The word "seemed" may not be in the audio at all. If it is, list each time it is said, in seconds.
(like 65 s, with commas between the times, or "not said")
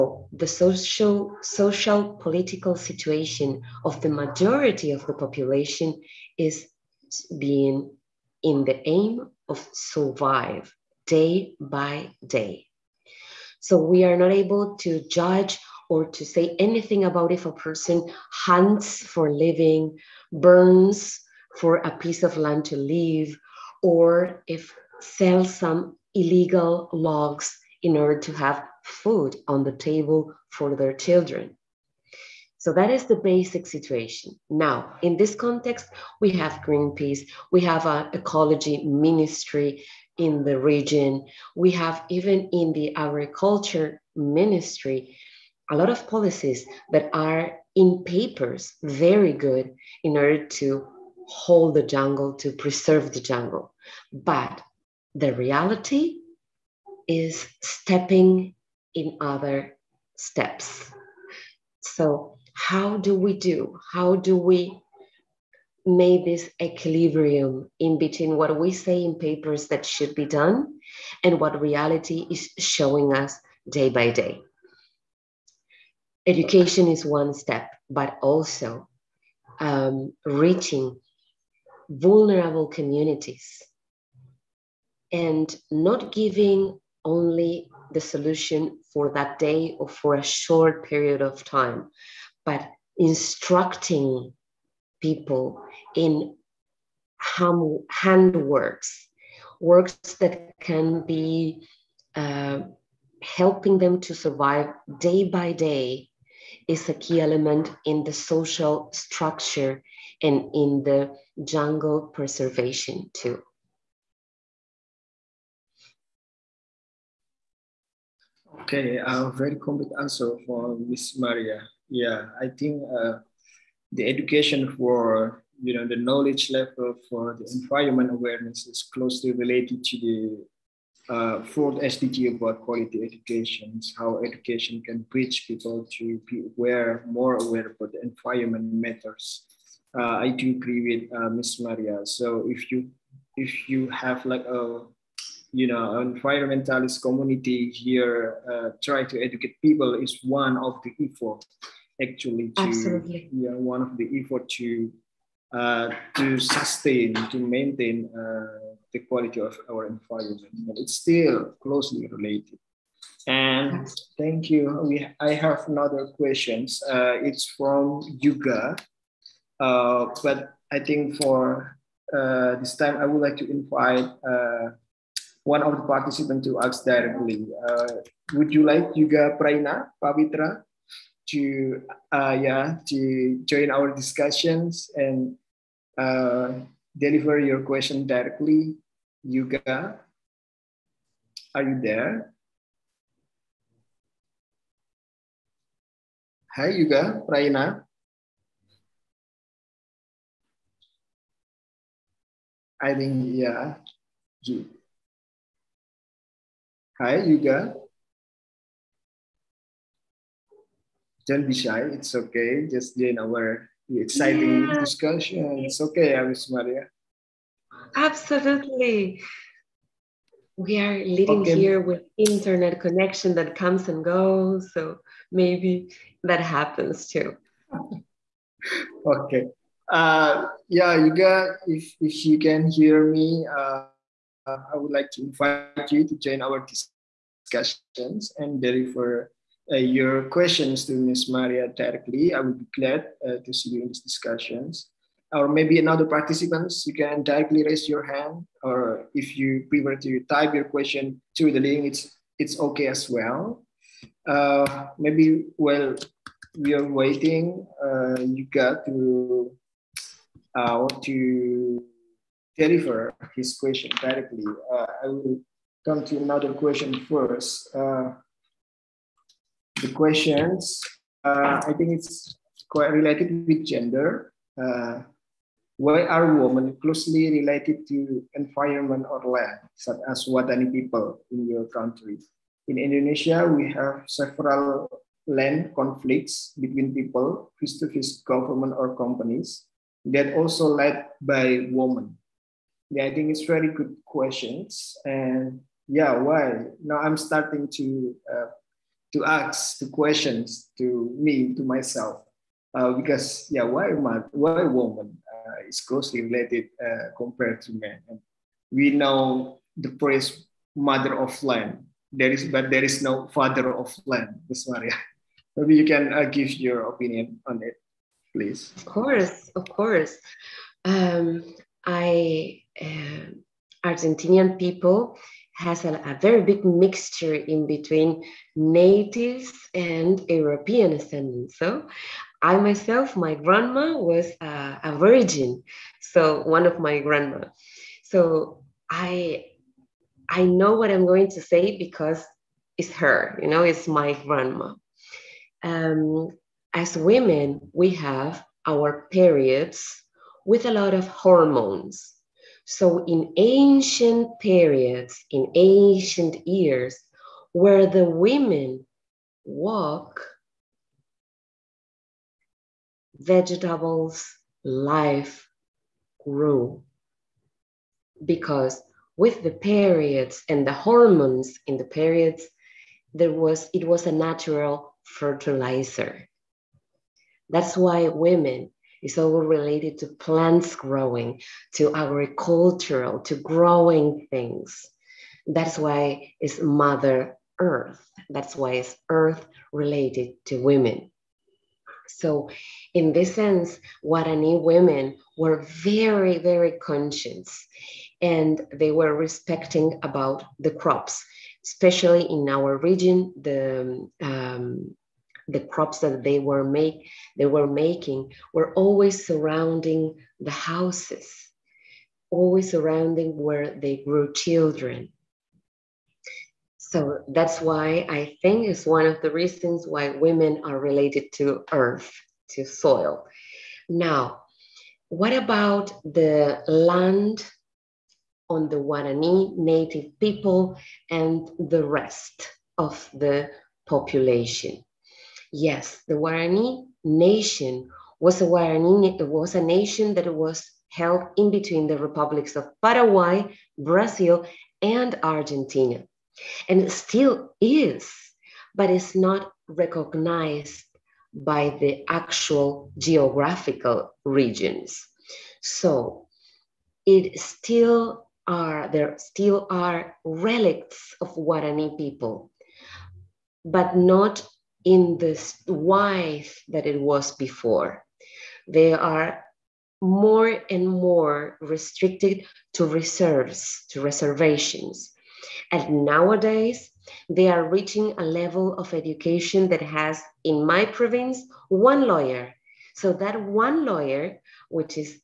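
not said.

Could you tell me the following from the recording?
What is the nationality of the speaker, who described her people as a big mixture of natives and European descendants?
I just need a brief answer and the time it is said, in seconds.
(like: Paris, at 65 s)
Argentinian, at 323 s.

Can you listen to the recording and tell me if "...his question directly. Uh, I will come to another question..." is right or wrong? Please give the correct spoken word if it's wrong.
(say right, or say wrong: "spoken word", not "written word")
right.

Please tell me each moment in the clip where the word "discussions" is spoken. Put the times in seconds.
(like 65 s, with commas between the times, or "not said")
183 s, 237 s, 244 s.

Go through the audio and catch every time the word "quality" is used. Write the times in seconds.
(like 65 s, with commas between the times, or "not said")
132 s, 159 s.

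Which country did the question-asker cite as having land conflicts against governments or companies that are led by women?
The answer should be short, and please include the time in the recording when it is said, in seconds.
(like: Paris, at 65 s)
Indonesia, at 282 s.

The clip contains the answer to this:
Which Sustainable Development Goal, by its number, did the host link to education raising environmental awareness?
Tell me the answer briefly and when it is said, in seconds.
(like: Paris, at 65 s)
fourth, at 131 s.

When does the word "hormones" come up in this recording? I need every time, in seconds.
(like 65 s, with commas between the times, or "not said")
351 s, 370 s.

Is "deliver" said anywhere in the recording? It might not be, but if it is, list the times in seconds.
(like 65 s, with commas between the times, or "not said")
186 s, 238 s, 262 s.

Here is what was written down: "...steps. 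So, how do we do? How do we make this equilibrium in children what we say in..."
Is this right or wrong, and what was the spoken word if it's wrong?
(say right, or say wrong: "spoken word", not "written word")
wrong: "between", not "children".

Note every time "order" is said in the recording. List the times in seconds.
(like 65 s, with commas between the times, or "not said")
27 s, 50 s.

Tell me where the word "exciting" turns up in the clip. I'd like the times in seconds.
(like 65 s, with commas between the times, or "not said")
214 s.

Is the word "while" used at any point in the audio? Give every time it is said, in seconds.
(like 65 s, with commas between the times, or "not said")
255 s.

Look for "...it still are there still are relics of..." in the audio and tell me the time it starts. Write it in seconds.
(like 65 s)
457 s.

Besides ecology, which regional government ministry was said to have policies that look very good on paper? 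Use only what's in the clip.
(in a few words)
agriculture ministry.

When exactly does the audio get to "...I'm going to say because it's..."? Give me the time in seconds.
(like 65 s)
340 s.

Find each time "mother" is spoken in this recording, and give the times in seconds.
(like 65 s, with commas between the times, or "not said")
310 s, 386 s.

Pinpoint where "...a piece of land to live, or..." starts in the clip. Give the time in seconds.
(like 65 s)
21 s.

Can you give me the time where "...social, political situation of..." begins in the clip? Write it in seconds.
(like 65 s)
1 s.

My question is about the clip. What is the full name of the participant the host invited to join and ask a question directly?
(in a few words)
Yuga Praina Pavitra.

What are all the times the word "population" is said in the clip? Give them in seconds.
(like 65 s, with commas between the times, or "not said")
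5 s, 433 s.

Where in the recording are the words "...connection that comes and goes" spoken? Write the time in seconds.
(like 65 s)
222 s.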